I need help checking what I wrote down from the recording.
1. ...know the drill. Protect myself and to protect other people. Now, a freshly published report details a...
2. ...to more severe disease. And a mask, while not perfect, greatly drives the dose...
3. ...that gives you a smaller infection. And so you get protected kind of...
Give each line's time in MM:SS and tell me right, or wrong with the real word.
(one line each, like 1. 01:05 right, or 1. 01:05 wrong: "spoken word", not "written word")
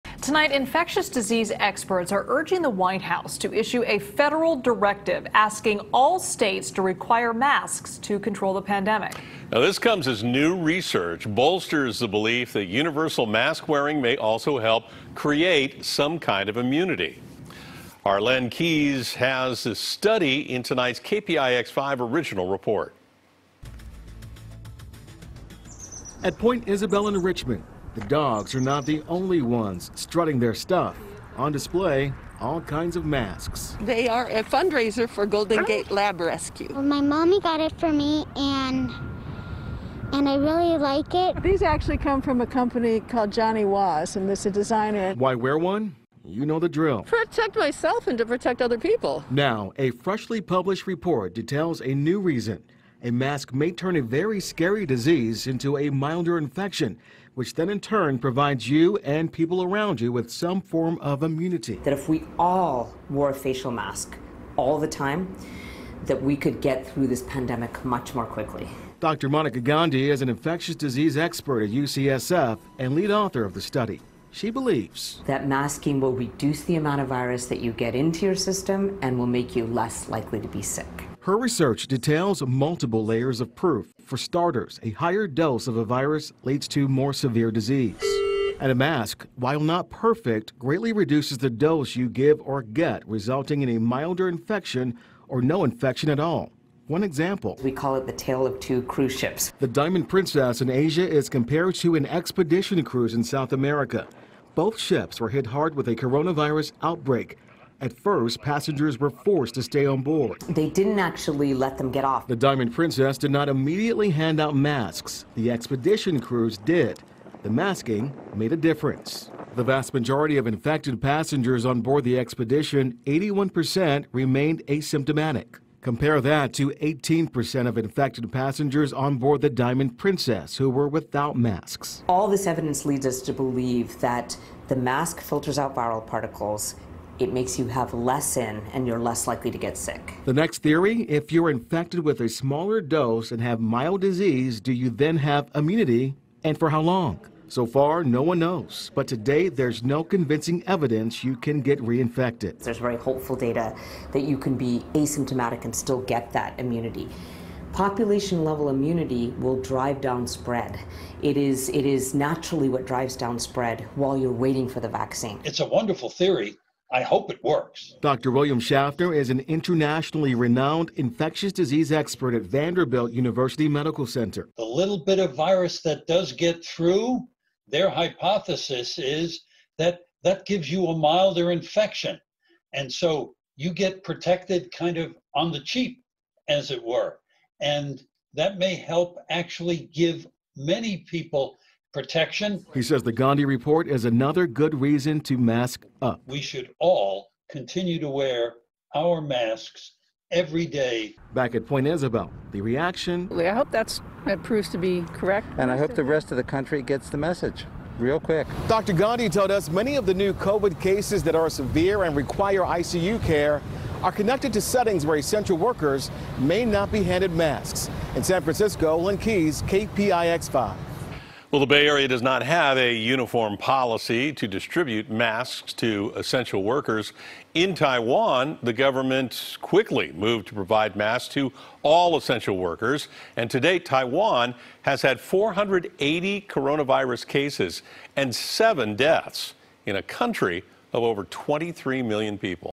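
1. 00:46 right
2. 01:26 wrong: "reduces", not "drives"
3. 03:00 wrong: "milder", not "smaller".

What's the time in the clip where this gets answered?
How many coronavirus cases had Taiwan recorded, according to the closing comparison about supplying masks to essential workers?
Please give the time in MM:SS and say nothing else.
03:55.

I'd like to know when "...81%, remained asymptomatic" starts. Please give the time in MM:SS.
02:03.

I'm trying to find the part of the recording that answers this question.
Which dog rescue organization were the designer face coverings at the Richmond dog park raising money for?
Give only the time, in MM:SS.
00:35.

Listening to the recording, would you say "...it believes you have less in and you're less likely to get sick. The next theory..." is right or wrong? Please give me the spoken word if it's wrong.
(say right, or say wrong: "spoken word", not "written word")
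wrong: "makes", not "believes".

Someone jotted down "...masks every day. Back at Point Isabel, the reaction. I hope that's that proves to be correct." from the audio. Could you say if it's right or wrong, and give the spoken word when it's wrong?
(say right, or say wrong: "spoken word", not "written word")
right.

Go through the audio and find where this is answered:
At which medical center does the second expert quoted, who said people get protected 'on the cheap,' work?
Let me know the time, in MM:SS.
02:52.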